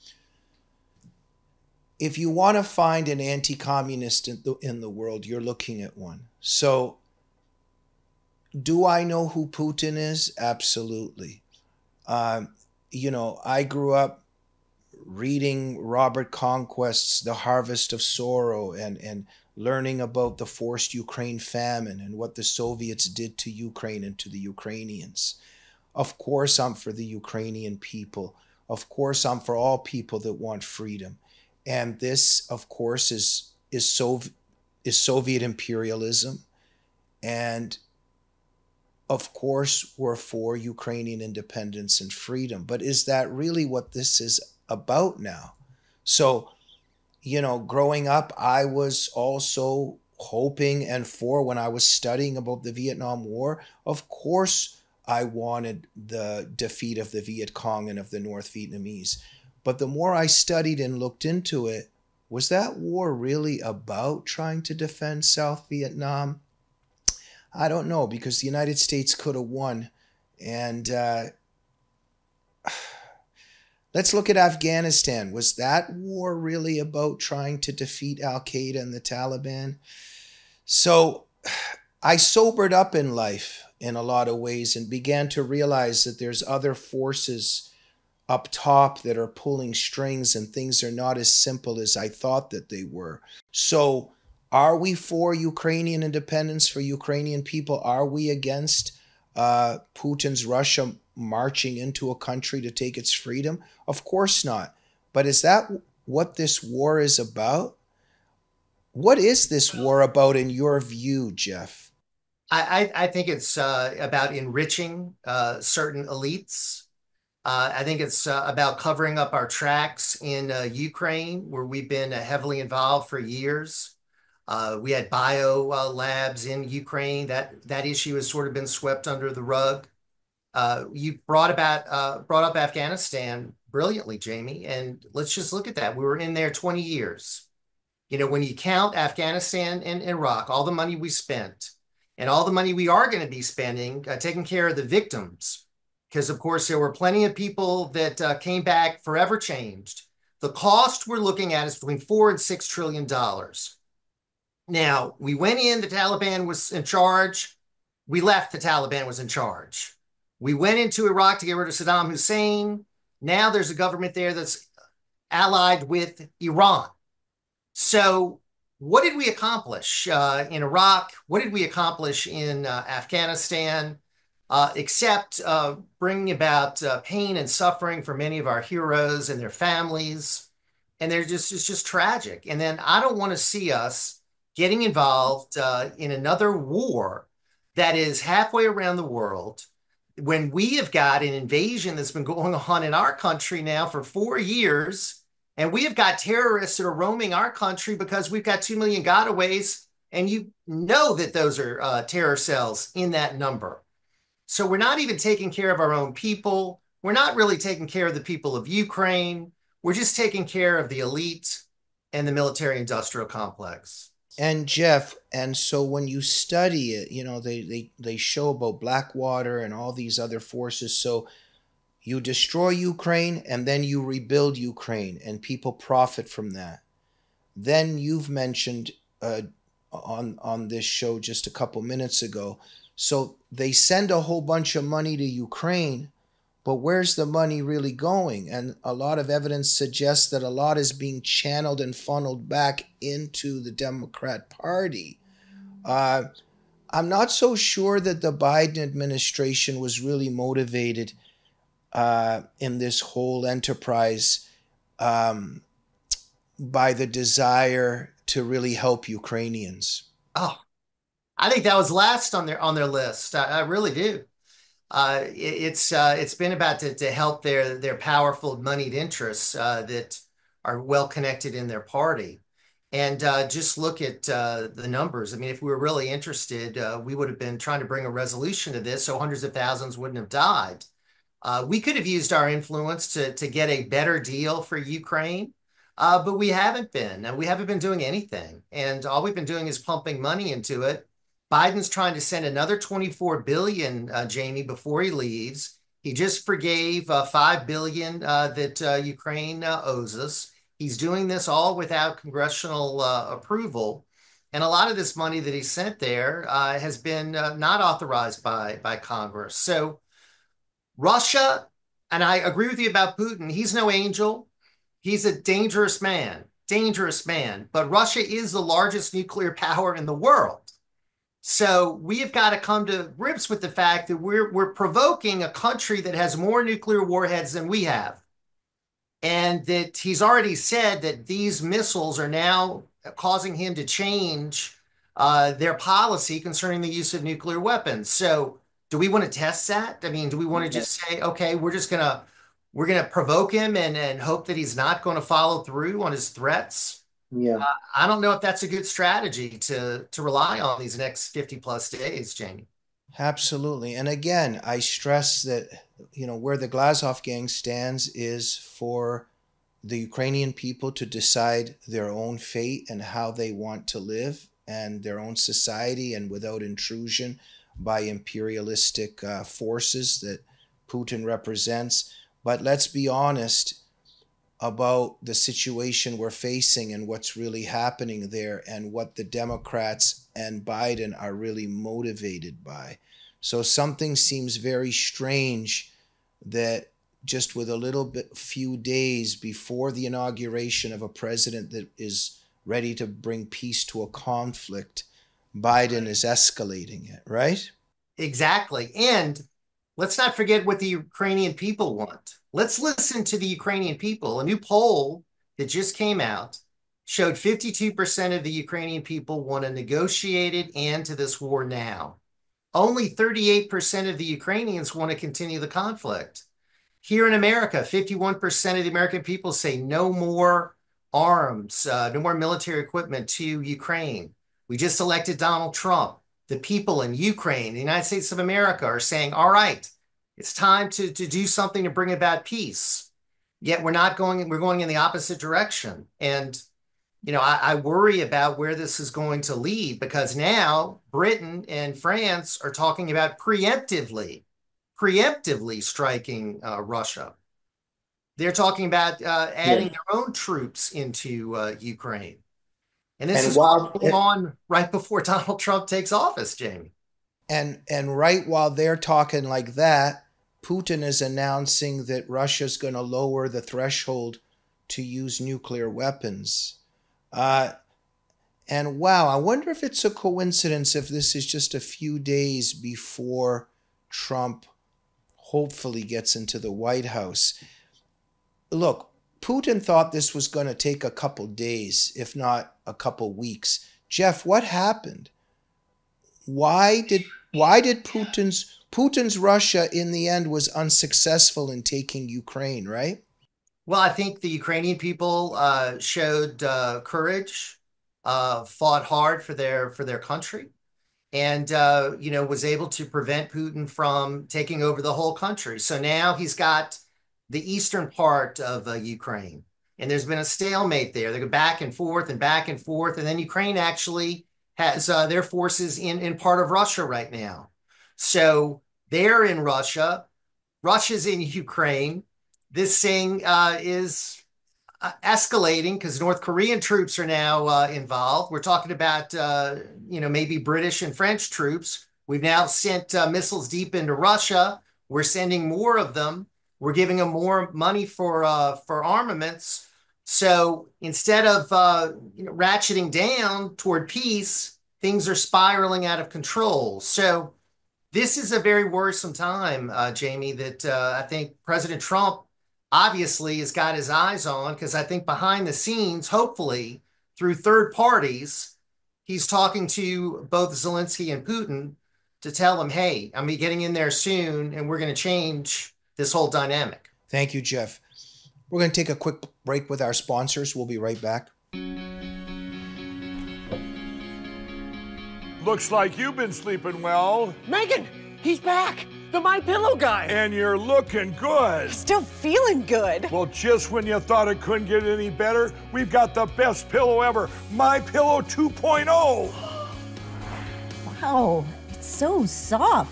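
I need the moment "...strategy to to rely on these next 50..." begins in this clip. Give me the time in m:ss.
5:48.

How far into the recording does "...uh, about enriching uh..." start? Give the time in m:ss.
1:53.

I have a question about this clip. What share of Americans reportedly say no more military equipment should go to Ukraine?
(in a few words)
51%.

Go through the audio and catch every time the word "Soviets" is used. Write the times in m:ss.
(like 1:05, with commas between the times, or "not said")
0:22, 0:34.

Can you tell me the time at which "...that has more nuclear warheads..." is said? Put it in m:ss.
5:26.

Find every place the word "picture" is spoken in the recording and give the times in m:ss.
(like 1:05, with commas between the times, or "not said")
not said.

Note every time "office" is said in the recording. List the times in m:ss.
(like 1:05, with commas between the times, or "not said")
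7:36.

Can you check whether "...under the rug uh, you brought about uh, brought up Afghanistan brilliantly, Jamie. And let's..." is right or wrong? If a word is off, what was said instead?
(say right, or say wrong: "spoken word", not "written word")
right.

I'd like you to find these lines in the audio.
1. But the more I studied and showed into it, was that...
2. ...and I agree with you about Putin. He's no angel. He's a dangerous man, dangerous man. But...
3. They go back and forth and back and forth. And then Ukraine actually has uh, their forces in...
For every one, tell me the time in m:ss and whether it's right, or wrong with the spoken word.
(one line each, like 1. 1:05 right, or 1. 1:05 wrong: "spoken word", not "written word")
1. 0:59 wrong: "looked", not "showed"
2. 5:12 right
3. 8:31 right.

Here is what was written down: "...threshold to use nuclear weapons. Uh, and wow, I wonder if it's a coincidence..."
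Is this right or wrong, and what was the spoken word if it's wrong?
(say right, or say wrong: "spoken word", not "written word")
right.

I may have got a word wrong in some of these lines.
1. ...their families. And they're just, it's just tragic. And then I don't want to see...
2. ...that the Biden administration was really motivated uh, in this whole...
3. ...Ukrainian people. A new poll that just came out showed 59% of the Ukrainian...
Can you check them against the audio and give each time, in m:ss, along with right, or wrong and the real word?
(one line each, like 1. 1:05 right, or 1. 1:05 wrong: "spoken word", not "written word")
1. 2:59 right
2. 4:07 right
3. 6:43 wrong: "52", not "59".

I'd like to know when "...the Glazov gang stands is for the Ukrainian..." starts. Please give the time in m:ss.
5:56.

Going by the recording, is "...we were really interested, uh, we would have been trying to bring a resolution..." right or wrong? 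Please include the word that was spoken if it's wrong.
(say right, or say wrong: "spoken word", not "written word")
right.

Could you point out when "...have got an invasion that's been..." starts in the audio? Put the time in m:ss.
3:10.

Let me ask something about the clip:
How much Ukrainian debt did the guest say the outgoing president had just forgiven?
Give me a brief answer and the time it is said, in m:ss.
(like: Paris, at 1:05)
5 billion, at 4:57.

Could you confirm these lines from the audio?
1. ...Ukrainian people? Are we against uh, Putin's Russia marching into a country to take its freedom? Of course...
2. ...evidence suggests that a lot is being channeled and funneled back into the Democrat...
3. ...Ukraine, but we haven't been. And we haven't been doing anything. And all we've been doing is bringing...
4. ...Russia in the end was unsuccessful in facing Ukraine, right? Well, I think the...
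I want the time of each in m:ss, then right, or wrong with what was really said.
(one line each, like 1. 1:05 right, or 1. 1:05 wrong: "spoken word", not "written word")
1. 1:36 right
2. 3:59 right
3. 4:44 wrong: "pumping", not "bringing"
4. 8:09 wrong: "taking", not "facing".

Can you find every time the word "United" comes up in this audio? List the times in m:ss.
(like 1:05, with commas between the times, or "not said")
1:08, 7:07.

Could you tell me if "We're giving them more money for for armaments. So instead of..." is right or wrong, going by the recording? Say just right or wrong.
right.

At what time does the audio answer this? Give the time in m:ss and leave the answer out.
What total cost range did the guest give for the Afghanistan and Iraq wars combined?
2:31.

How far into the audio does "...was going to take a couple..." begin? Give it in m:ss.
8:00.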